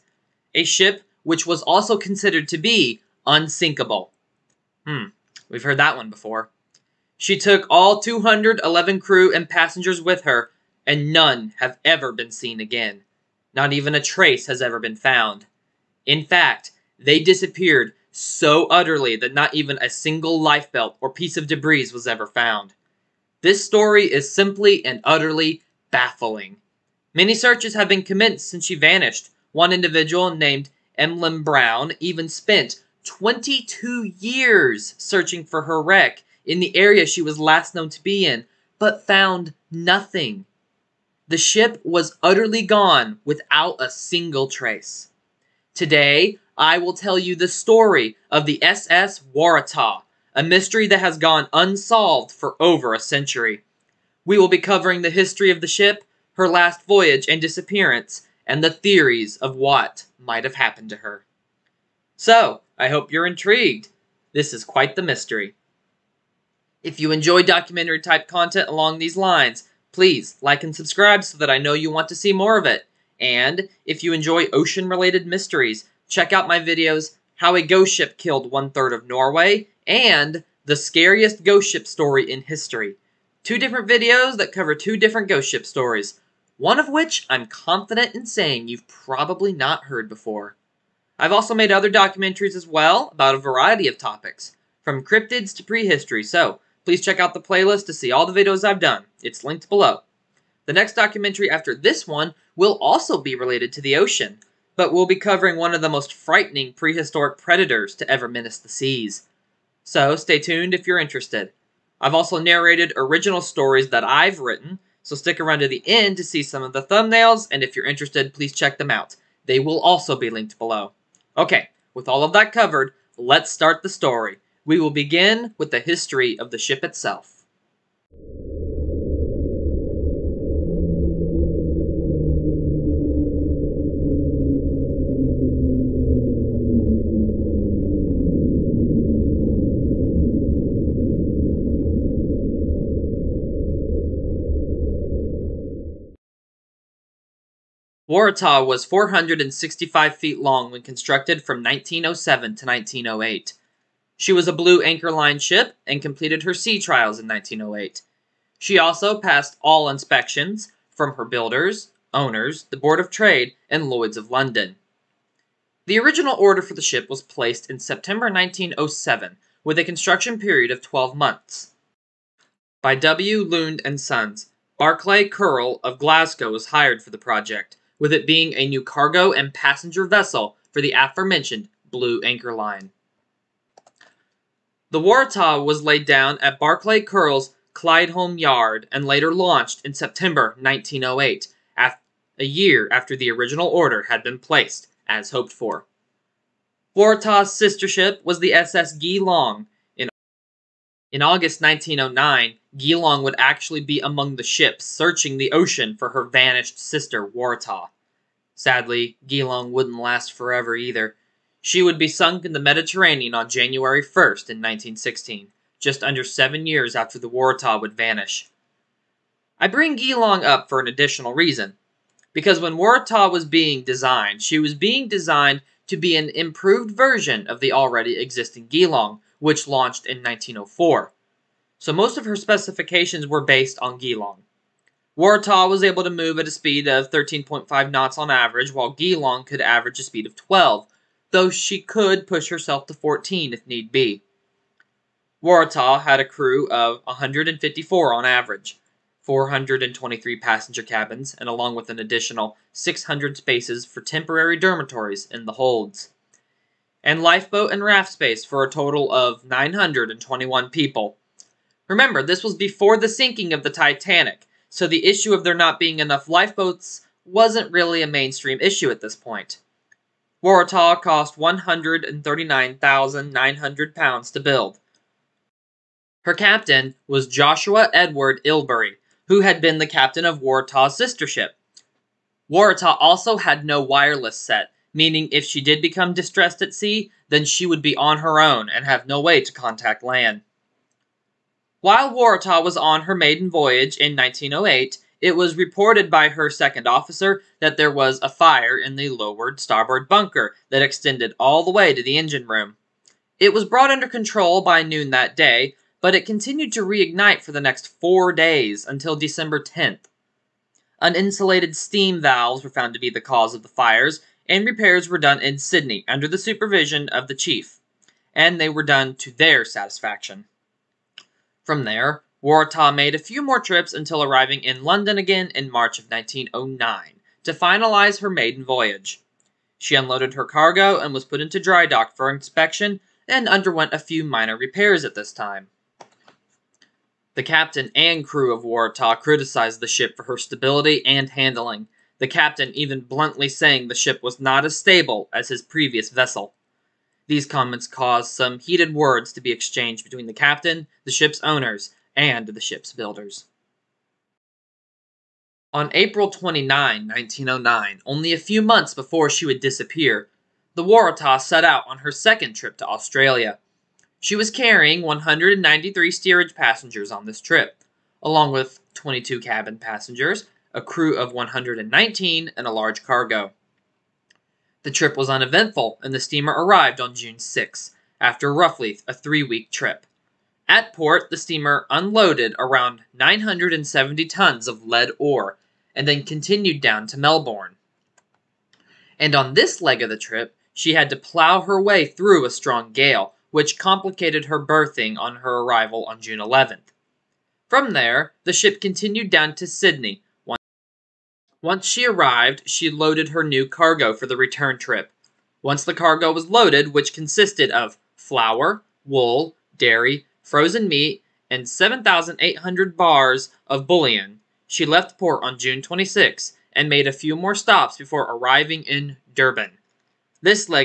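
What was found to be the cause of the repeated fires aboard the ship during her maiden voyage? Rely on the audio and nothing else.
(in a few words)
Uninsulated steam valves.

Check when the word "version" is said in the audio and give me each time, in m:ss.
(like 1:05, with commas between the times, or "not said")
3:46.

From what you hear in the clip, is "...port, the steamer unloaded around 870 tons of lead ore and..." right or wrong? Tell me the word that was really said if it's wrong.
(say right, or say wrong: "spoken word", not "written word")
wrong: "970", not "870".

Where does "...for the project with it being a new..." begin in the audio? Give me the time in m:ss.
2:57.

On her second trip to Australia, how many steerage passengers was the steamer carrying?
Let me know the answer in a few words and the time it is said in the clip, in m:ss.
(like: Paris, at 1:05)
193, at 6:05.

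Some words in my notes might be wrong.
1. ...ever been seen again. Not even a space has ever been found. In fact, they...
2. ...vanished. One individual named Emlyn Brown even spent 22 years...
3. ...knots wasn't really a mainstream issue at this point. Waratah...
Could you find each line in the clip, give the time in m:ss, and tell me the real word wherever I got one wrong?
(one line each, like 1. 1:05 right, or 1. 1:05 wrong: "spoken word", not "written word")
1. 0:11 wrong: "trace", not "space"
2. 0:28 right
3. 4:26 wrong: "lifeboats", not "knots".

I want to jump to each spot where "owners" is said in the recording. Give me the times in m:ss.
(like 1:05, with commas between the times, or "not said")
2:42, 5:51.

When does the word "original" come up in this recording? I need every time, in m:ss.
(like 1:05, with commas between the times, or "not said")
1:52, 2:46, 3:13.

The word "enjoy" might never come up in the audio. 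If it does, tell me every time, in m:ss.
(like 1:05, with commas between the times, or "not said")
1:07, 1:14.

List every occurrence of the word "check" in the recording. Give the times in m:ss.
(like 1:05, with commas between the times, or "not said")
1:16, 1:37, 1:58.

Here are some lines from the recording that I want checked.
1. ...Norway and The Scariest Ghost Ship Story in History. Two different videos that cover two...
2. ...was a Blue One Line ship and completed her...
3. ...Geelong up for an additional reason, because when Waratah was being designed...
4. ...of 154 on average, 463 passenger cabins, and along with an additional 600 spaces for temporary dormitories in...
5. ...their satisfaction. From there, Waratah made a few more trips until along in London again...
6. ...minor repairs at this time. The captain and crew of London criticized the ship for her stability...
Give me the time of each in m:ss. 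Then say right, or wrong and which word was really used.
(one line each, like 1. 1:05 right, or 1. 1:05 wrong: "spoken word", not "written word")
1. 1:19 right
2. 2:34 wrong: "Anchor", not "One"
3. 3:39 right
4. 4:06 wrong: "423", not "463"
5. 5:19 wrong: "arriving", not "along"
6. 5:34 wrong: "Waratah", not "London".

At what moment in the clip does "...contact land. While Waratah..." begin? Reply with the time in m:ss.
4:49.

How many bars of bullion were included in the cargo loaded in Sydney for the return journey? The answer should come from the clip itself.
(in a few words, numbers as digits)
7,800.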